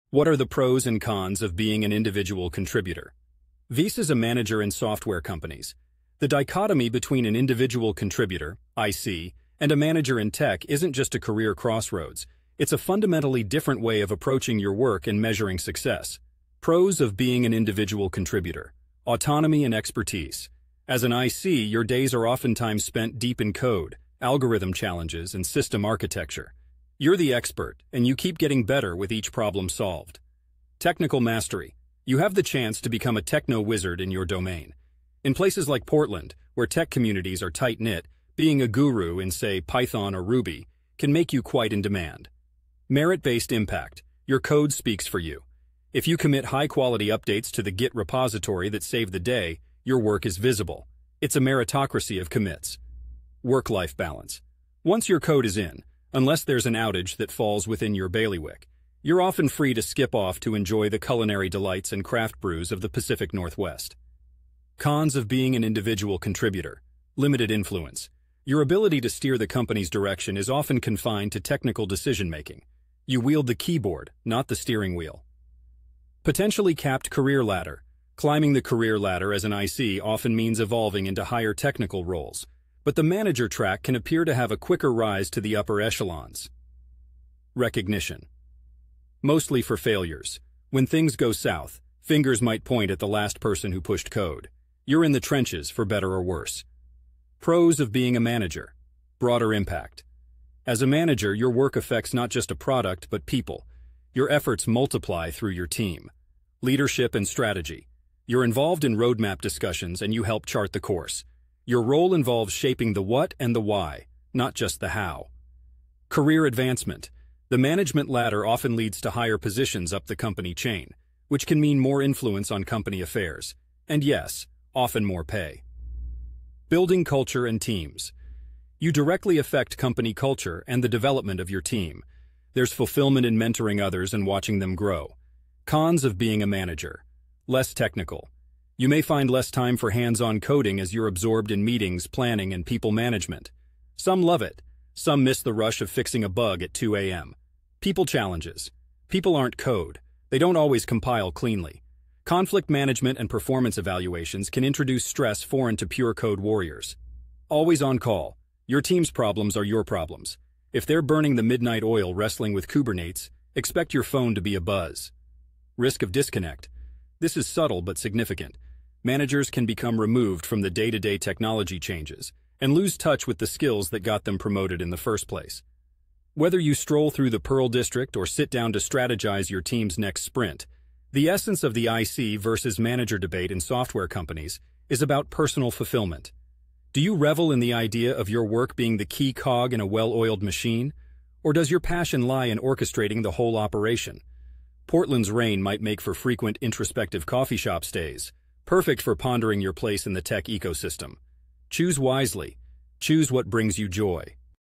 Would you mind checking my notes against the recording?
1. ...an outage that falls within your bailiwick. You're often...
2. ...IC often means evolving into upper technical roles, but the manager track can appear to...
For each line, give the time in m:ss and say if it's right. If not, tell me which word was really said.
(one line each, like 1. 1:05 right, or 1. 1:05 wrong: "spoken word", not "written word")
1. 0:56 right
2. 1:19 wrong: "higher", not "upper".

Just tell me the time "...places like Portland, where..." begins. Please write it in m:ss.
0:35.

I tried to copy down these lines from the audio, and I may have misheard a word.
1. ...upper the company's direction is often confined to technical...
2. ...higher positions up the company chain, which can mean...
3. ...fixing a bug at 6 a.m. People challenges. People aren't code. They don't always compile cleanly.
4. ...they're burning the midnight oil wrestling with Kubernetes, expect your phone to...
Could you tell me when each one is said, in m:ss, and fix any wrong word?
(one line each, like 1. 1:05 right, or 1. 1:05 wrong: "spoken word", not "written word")
1. 1:09 wrong: "steer", not "upper"
2. 1:59 right
3. 2:25 wrong: "2", not "6"
4. 2:40 right.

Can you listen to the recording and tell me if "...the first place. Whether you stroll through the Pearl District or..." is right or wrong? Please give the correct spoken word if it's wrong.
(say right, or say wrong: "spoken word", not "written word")
right.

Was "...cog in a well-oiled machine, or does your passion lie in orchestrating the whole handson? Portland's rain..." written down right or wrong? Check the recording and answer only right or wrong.
wrong.